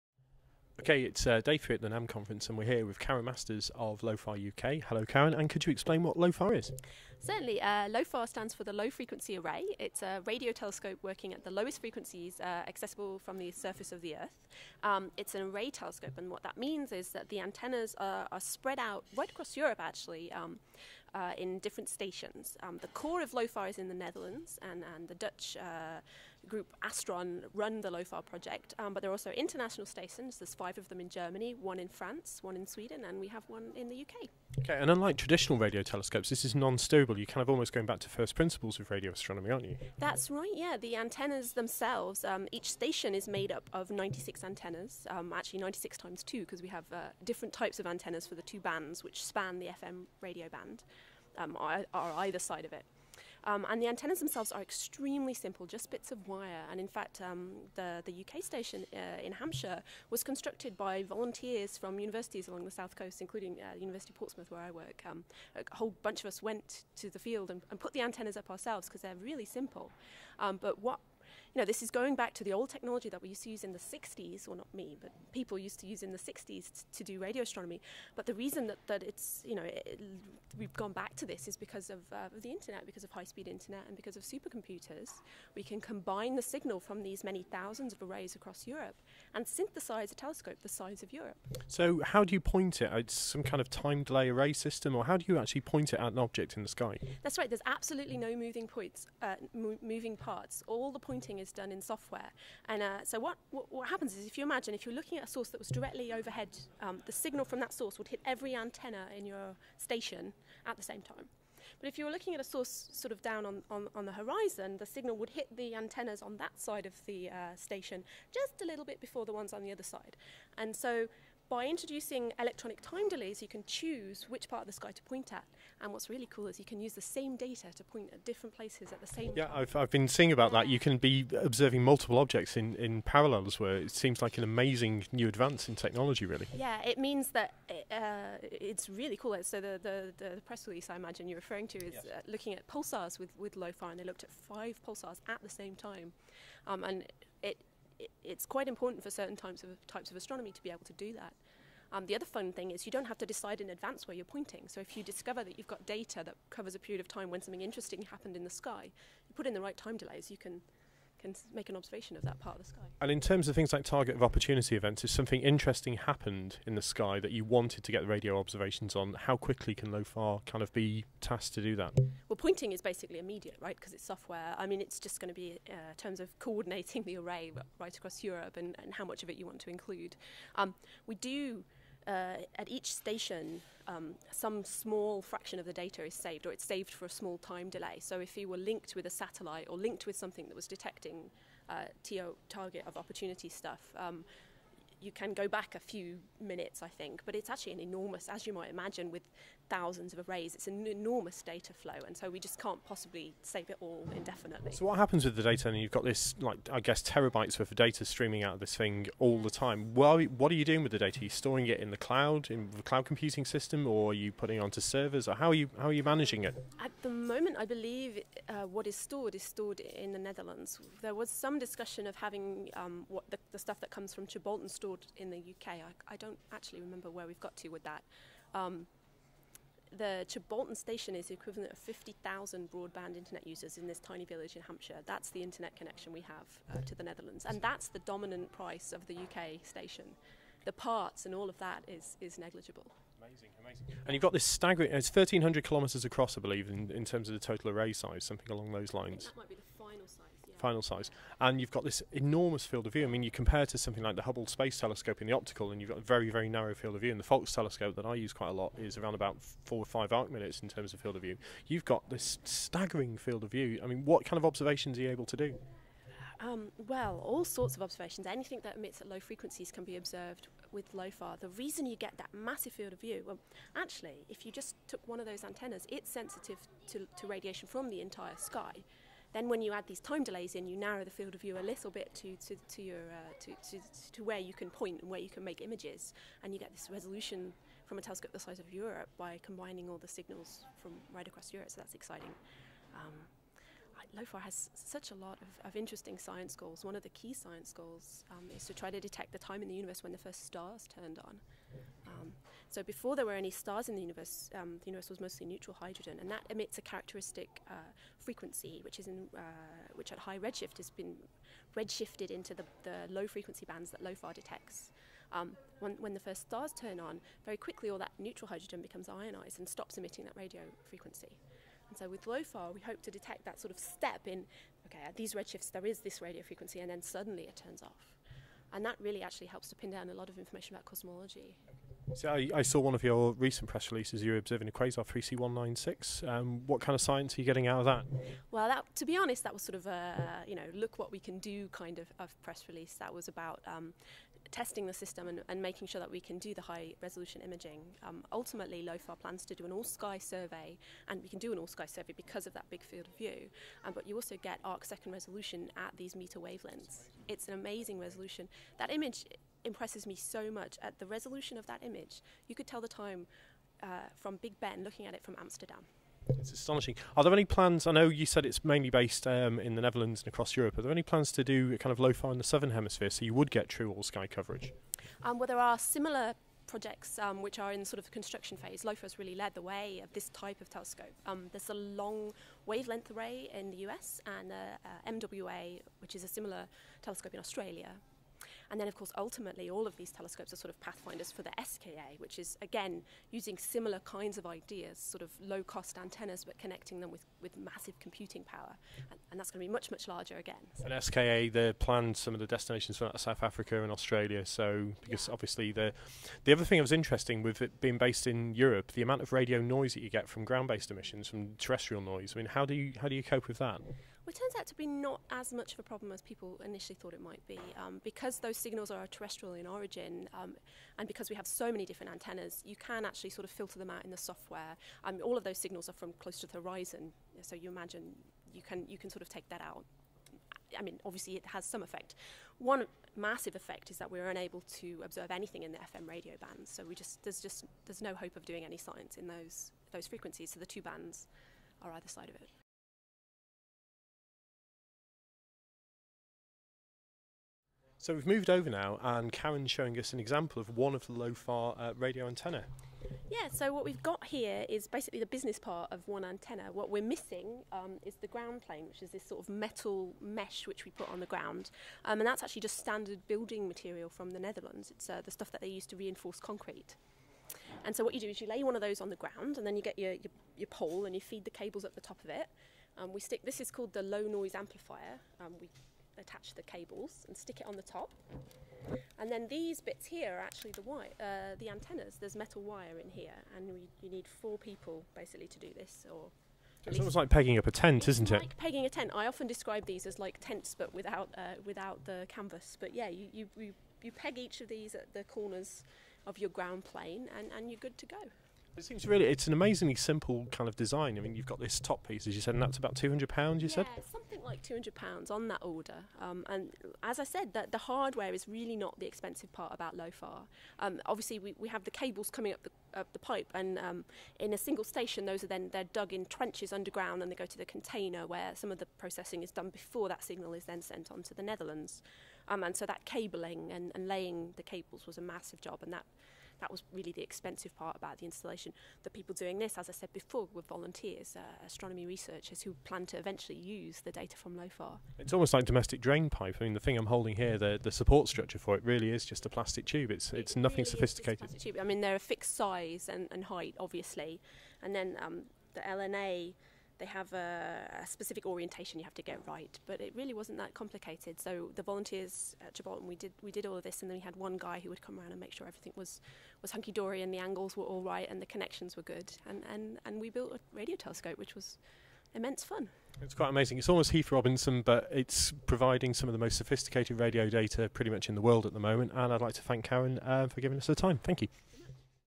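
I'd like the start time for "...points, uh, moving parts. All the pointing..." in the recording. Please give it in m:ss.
1:38.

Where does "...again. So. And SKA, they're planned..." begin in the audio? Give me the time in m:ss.
6:40.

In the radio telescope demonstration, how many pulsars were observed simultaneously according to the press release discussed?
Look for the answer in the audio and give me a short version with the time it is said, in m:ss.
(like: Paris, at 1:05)
5, at 2:24.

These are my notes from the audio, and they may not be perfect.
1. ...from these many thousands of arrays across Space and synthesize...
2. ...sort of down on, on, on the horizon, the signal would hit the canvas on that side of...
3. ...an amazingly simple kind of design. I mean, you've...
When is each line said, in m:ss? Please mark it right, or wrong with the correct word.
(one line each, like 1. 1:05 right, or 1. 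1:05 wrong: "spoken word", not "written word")
1. 1:26 wrong: "Europe", not "Space"
2. 1:52 wrong: "antennas", not "canvas"
3. 8:19 right.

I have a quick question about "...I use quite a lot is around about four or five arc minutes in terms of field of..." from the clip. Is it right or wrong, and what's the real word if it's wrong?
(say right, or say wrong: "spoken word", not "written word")
right.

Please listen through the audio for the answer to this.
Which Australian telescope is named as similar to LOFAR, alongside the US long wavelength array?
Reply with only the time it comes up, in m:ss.
6:25.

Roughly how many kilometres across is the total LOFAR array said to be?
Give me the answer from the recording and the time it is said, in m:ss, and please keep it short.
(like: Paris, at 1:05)
1,300, at 4:05.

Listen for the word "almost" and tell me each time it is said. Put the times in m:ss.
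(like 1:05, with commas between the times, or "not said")
0:37, 8:06, 8:55, 9:23.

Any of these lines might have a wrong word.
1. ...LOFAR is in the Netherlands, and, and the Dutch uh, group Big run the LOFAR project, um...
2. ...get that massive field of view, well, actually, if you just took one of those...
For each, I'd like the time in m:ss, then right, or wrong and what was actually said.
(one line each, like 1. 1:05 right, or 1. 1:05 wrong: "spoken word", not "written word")
1. 0:23 wrong: "Astron", not "Big"
2. 4:31 right.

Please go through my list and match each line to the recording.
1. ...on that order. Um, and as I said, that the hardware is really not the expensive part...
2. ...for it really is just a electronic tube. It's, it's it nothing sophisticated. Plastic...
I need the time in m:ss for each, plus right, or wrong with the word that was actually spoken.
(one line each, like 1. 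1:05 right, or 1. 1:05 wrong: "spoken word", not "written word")
1. 8:25 right
2. 8:58 wrong: "plastic", not "electronic".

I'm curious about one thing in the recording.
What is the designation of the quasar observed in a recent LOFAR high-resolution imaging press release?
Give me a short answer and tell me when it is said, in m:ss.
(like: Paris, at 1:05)
3C196, at 5:35.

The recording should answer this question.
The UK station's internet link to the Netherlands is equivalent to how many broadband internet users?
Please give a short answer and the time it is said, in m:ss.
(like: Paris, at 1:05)
50,000, at 3:51.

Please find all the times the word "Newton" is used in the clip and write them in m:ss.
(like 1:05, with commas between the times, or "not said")
not said.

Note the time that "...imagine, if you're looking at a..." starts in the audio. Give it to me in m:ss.
1:44.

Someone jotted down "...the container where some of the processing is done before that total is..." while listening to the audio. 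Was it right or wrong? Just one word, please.
wrong.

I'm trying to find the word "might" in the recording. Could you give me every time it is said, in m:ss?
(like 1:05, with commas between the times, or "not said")
3:18, 6:57.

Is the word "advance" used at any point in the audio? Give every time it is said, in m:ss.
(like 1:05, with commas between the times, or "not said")
2:15, 2:33.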